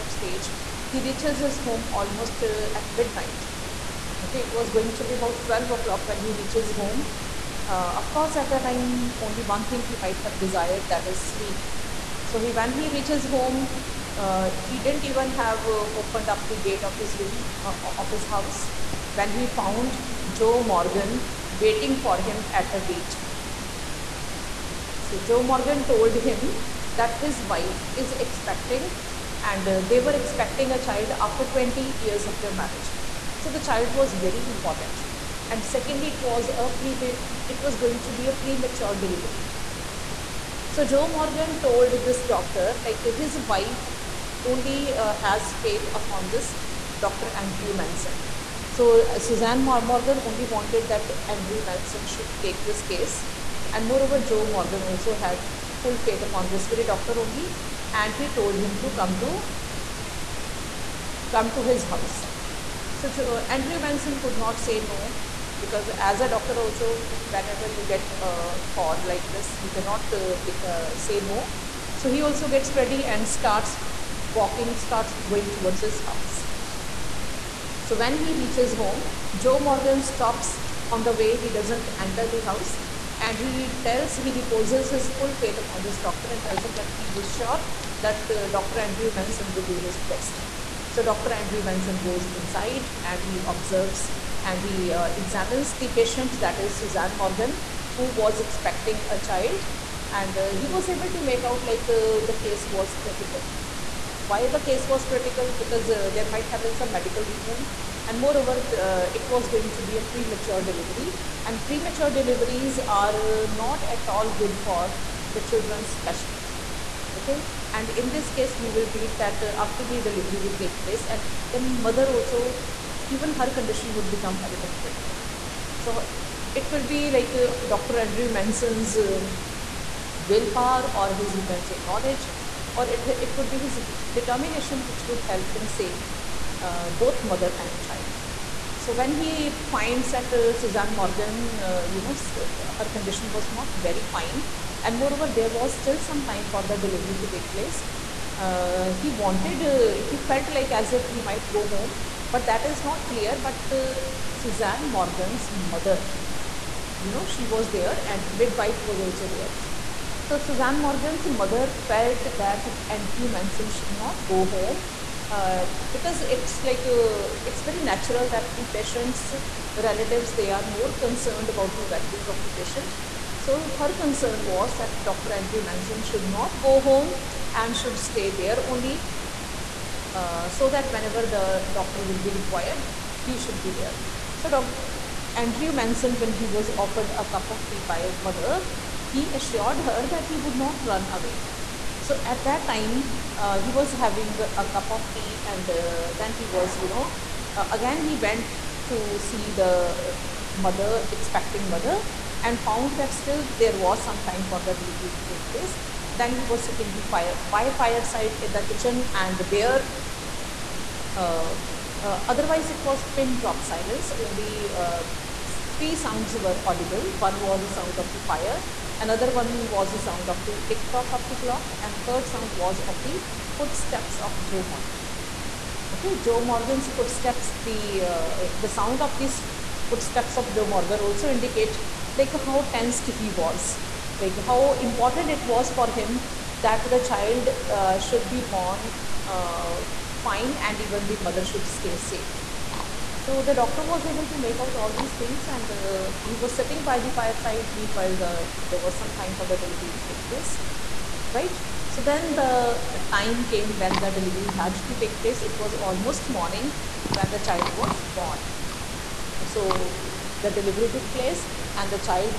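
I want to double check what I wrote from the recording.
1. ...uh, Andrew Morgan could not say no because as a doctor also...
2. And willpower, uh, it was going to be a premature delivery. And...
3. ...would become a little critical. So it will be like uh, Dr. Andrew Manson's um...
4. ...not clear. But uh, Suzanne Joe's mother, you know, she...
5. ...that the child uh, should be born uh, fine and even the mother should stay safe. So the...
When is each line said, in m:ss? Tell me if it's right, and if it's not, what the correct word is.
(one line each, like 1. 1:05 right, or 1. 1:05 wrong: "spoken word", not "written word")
1. 1:03 wrong: "Manson", not "Morgan"
2. 1:48 wrong: "moreover", not "willpower"
3. 2:03 right
4. 2:32 wrong: "Morgan", not "Joe"
5. 3:56 right.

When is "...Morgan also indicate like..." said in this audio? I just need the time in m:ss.
3:50.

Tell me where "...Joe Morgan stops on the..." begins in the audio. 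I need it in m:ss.
1:19.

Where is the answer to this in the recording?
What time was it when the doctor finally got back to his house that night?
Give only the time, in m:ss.
0:05.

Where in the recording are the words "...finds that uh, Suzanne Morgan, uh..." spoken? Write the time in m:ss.
2:19.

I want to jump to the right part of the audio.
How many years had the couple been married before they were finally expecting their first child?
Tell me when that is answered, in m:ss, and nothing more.
0:31.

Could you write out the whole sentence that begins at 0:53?
And moreover, Joe Morgan also had full faith upon this very doctor only.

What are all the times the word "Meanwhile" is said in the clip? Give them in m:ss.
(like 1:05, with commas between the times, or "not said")
4:07.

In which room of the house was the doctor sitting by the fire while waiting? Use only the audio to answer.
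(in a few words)
the kitchen.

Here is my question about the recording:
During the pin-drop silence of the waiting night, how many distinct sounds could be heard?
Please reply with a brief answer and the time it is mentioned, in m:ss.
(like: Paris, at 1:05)
3, at 3:35.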